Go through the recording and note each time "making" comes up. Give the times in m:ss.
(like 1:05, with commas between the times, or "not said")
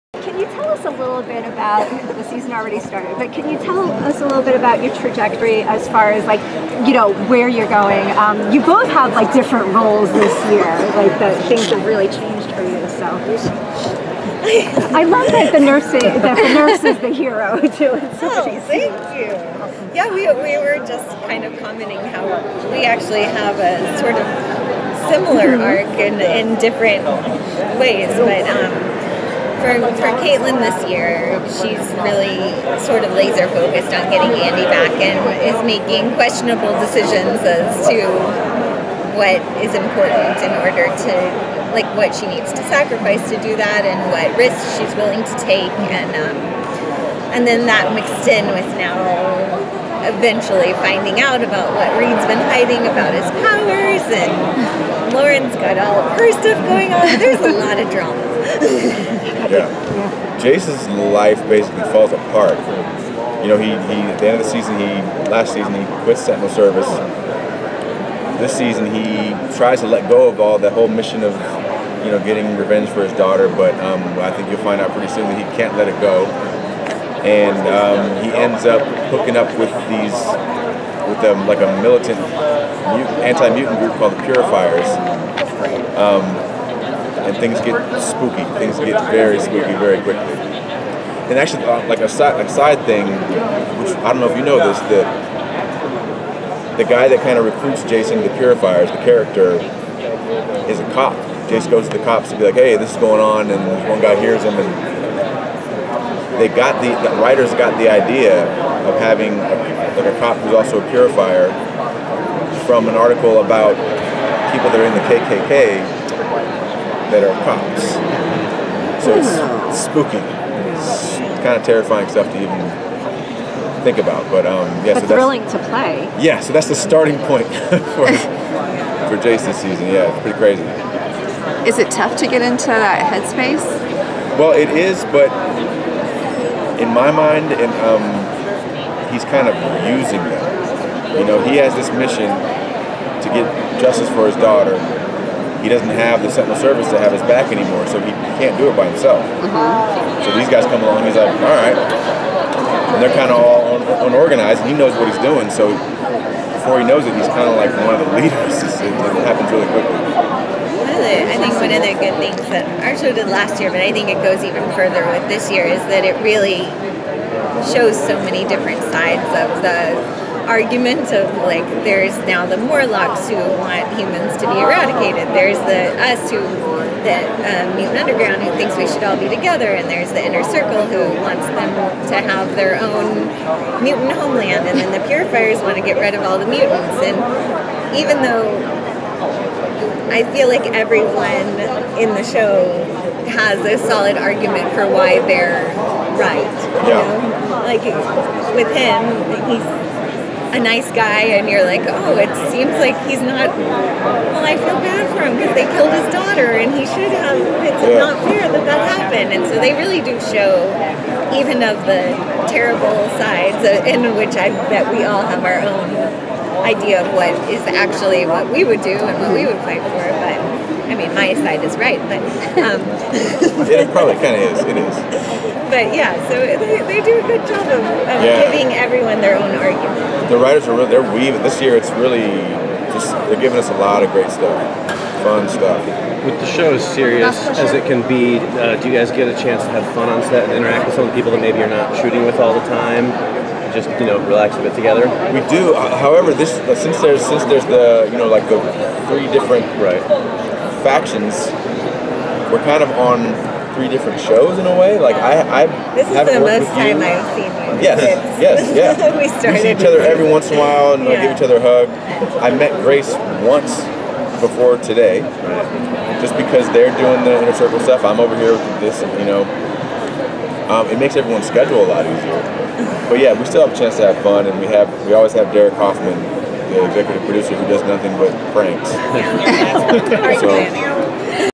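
0:35.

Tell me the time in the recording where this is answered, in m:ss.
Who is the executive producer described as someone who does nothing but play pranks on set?
4:35.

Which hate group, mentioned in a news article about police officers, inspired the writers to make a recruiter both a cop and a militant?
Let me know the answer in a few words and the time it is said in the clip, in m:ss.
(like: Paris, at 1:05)
KKK, at 1:55.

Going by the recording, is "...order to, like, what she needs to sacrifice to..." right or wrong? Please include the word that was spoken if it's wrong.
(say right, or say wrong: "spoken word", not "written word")
right.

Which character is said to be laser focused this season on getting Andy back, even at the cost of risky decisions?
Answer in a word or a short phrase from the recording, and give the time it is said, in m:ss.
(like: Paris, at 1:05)
Caitlin, at 0:30.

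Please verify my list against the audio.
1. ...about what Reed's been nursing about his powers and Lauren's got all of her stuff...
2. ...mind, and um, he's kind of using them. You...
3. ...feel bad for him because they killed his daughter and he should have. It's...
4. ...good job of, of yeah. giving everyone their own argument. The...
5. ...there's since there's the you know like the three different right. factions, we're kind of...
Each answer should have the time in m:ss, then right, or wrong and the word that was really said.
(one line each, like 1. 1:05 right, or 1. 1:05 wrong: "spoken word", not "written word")
1. 0:51 wrong: "hiding", not "nursing"
2. 2:17 right
3. 3:24 right
4. 3:47 right
5. 4:06 right.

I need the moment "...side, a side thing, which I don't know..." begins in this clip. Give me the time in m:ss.
1:32.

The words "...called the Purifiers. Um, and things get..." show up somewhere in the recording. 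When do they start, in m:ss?
1:23.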